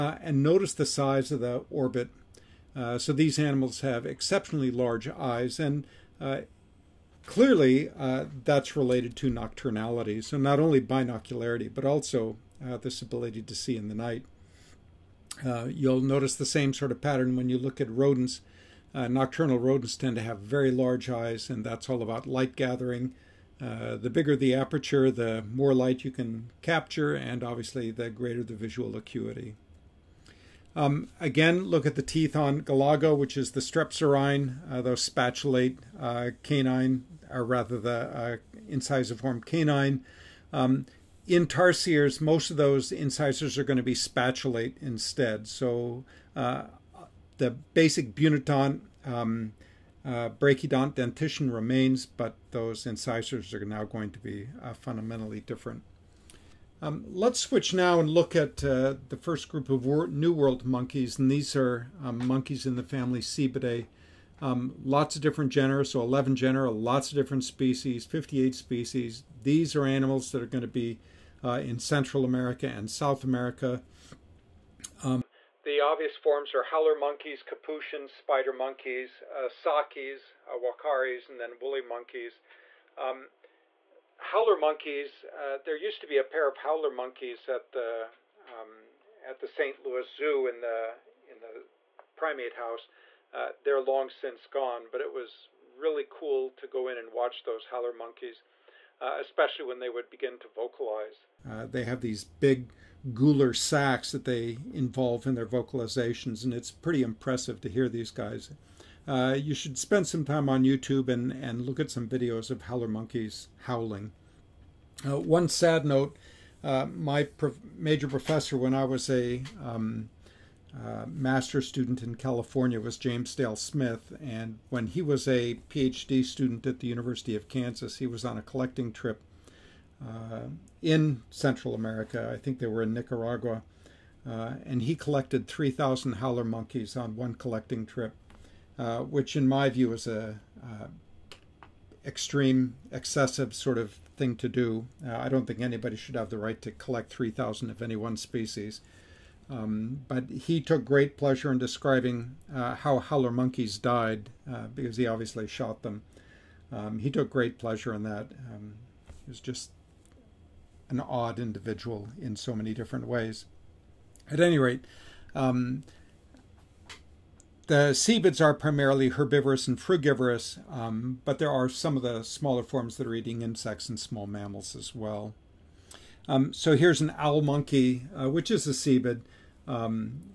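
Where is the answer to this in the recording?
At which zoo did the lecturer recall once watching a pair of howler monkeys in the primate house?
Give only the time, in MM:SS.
01:29.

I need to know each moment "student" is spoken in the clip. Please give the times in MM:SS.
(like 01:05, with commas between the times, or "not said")
02:01, 02:06.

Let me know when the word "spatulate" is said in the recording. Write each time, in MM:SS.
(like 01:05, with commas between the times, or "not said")
00:35, 00:43.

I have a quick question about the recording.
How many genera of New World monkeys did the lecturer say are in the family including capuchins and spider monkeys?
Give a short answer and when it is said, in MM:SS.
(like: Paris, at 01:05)
11, at 01:06.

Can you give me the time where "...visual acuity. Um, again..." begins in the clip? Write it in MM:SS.
00:28.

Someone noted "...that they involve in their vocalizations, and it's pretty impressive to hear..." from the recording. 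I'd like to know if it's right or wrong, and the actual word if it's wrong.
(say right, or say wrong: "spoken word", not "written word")
right.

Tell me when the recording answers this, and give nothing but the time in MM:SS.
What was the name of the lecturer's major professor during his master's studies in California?
02:02.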